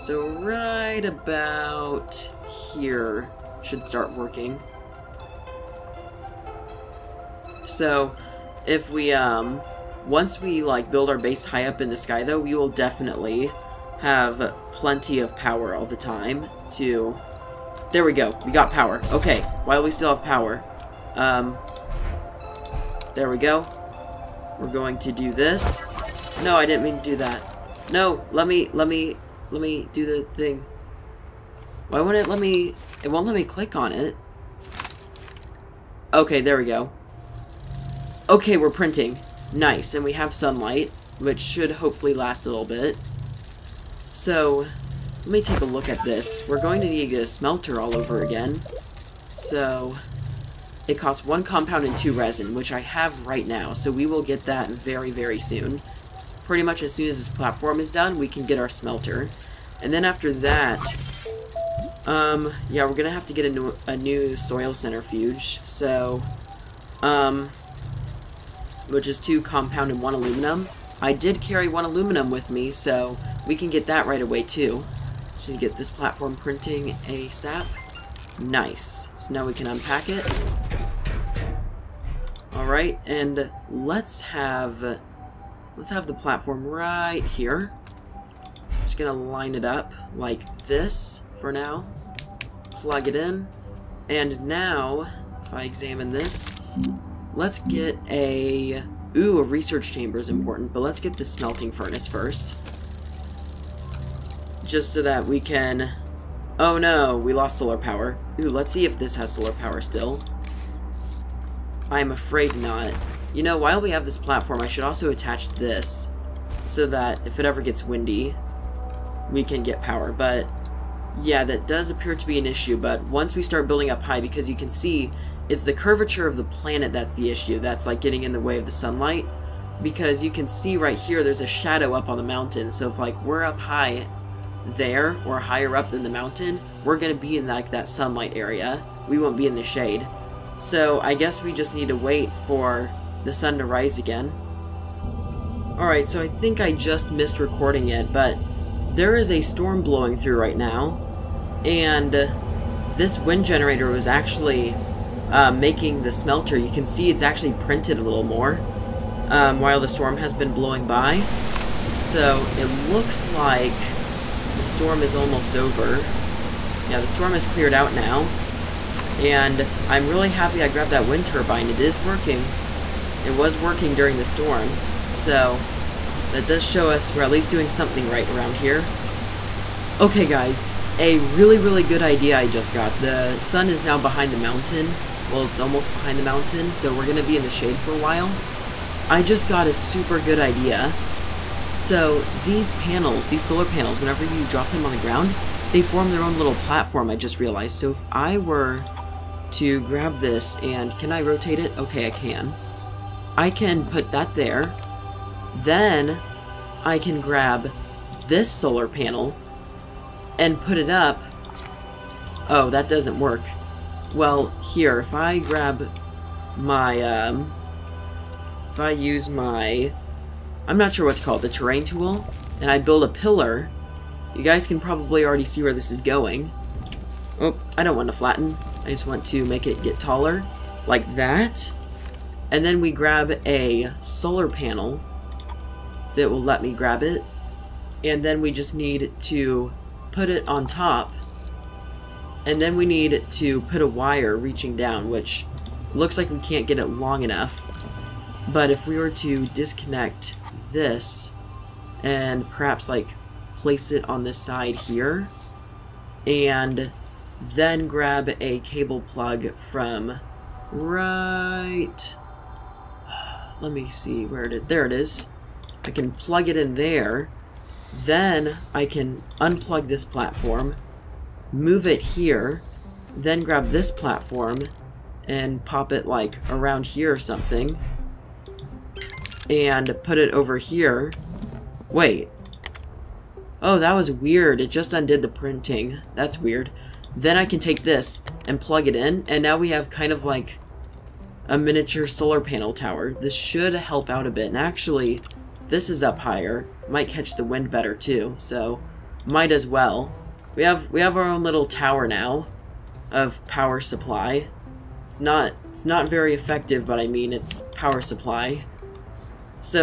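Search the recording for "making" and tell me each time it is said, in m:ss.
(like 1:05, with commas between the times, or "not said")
2:35.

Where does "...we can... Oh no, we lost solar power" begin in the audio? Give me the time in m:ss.
1:45.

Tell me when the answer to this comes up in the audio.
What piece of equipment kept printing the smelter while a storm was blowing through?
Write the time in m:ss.
2:33.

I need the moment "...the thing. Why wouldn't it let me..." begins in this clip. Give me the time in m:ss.
0:30.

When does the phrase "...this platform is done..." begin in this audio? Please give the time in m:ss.
0:57.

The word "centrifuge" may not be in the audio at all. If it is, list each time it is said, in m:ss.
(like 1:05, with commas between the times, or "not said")
1:04.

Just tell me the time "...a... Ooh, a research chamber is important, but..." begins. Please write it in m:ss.
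1:38.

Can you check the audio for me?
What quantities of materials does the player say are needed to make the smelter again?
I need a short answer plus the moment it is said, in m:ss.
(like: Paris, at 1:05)
1 compound and 2 resin, at 0:51.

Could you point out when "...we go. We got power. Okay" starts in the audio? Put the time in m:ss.
0:18.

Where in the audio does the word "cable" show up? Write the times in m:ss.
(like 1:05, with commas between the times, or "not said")
4:18.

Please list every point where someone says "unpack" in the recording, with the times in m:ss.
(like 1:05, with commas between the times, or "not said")
1:19.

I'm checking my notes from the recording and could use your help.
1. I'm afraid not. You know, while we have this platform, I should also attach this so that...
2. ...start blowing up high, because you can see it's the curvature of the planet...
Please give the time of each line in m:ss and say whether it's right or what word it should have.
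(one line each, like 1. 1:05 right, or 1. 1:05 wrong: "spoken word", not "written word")
1. 1:51 right
2. 2:03 wrong: "building", not "blowing".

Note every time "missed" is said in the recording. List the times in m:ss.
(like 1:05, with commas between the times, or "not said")
2:27.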